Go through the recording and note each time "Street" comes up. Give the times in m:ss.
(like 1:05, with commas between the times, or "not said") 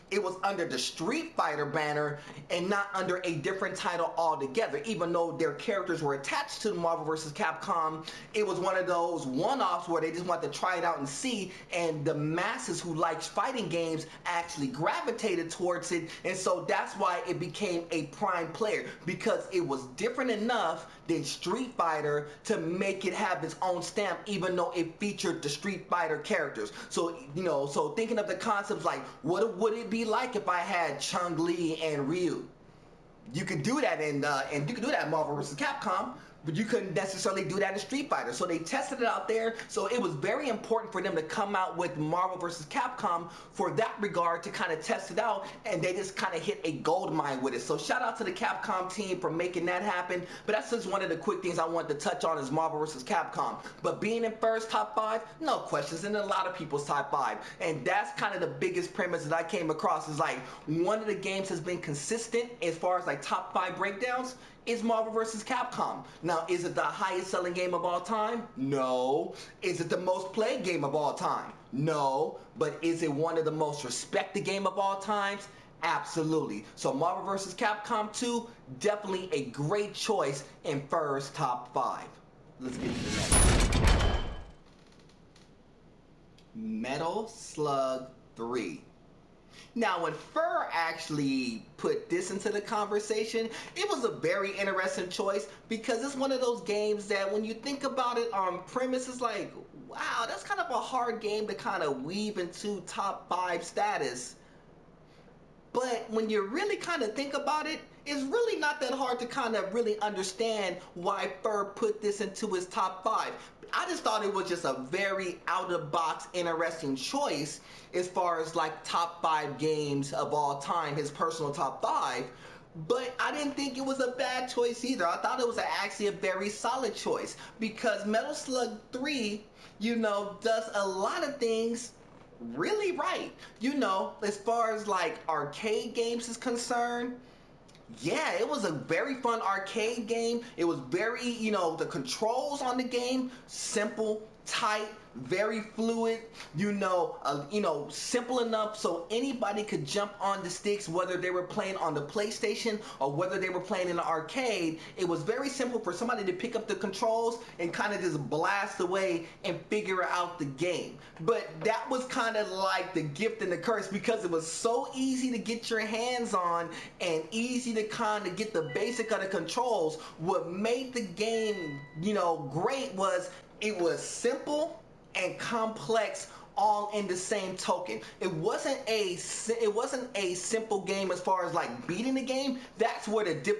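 0:00, 0:21, 0:25, 0:37.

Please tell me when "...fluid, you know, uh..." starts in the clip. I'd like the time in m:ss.
2:25.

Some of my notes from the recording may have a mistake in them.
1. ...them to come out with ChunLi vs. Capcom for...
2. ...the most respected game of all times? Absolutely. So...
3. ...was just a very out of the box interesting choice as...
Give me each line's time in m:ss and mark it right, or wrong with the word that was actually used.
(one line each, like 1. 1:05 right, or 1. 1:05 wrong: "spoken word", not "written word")
1. 0:41 wrong: "Marvel", not "ChunLi"
2. 1:13 right
3. 1:54 right.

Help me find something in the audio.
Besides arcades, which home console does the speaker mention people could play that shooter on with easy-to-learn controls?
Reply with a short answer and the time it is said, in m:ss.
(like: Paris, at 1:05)
PlayStation, at 2:32.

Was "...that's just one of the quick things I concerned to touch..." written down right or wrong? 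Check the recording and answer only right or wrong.
wrong.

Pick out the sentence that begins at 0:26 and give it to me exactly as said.
So, you know, so thinking of the concepts like, what would it be like if I had Chun-Li and Ryu?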